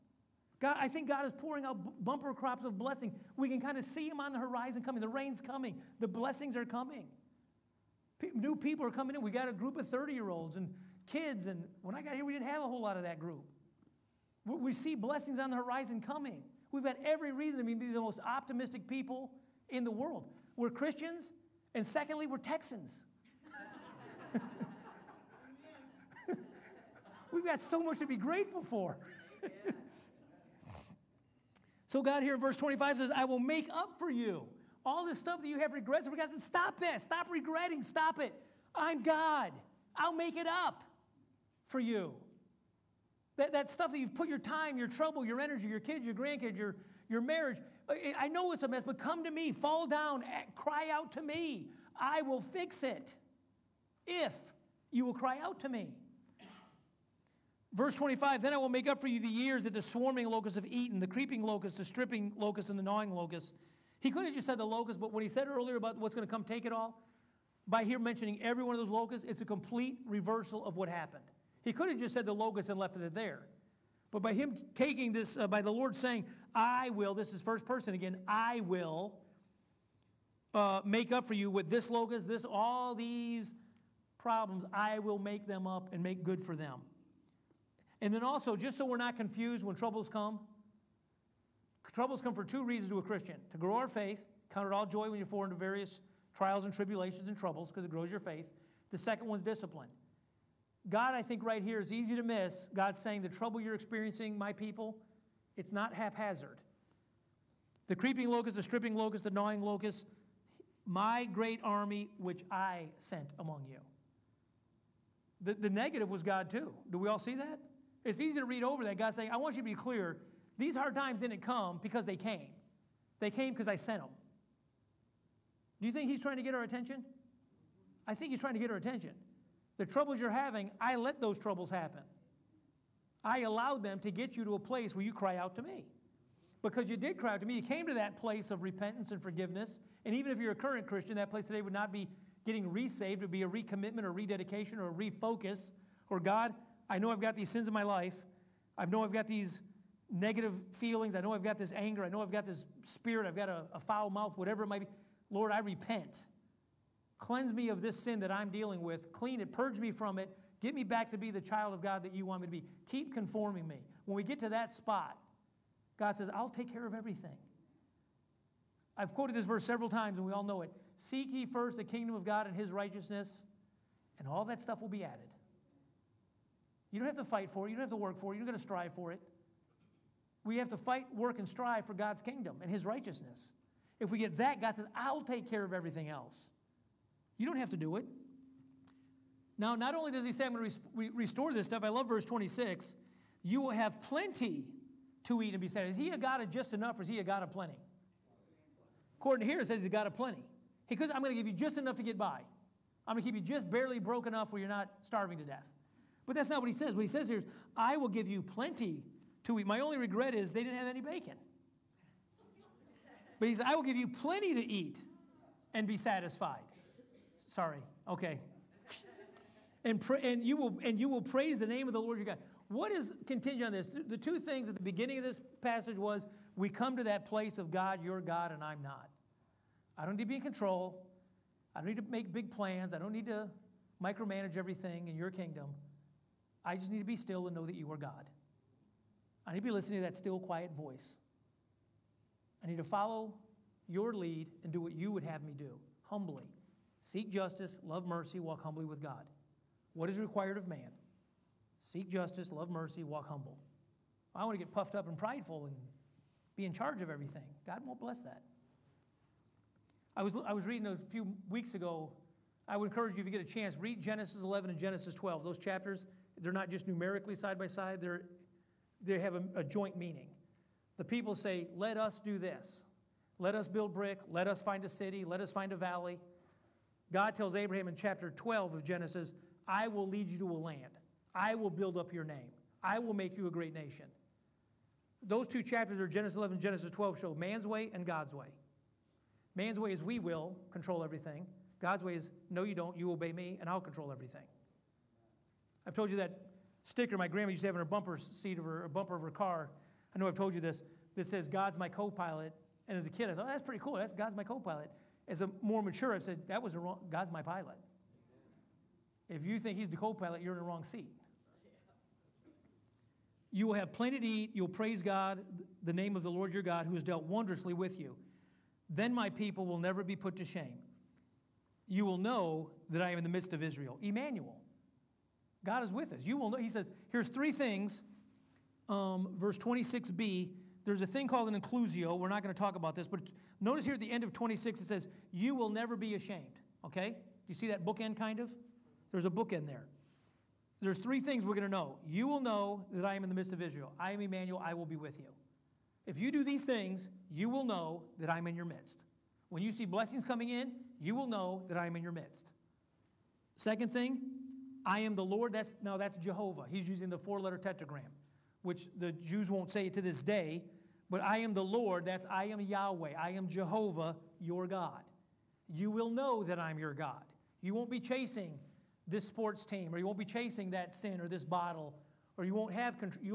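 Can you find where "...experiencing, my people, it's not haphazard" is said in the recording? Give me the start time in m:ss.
1:43.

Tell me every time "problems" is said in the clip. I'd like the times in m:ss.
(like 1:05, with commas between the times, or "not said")
1:24.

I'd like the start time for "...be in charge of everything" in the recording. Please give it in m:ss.
4:16.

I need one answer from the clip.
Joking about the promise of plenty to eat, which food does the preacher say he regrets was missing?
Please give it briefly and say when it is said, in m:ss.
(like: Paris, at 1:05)
bacon, at 3:31.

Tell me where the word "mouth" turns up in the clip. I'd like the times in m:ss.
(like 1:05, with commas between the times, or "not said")
2:34.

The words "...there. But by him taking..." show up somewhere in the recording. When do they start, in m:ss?
1:13.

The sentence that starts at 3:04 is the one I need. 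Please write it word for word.
If we get that, God says, I'll take care of everything else.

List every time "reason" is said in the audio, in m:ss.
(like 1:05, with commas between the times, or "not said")
0:17, 1:32.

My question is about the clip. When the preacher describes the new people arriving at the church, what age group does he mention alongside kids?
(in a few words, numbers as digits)
30 year olds.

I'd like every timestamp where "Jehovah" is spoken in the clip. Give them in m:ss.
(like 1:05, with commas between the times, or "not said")
5:56, 6:03.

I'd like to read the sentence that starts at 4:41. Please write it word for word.
I will build up your name.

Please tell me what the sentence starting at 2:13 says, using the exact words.
I allowed them to get you to a place where you cry out to me.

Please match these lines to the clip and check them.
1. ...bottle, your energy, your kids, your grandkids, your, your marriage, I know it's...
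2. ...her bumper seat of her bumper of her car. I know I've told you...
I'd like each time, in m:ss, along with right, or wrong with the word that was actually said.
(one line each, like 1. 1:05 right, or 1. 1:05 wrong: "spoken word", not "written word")
1. 0:44 wrong: "trouble", not "bottle"
2. 4:57 right.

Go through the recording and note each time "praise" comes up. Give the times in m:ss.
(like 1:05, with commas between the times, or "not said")
3:41, 5:14.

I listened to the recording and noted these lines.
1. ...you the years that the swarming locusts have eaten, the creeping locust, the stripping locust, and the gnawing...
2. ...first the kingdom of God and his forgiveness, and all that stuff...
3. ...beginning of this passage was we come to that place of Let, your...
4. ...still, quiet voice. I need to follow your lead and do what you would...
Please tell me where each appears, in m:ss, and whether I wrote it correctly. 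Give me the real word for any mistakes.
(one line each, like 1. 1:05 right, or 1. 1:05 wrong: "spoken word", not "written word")
1. 0:59 right
2. 2:51 wrong: "righteousness", not "forgiveness"
3. 3:44 wrong: "God", not "Let"
4. 4:00 right.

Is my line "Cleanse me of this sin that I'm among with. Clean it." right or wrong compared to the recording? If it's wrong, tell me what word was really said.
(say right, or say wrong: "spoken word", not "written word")
wrong: "dealing", not "among".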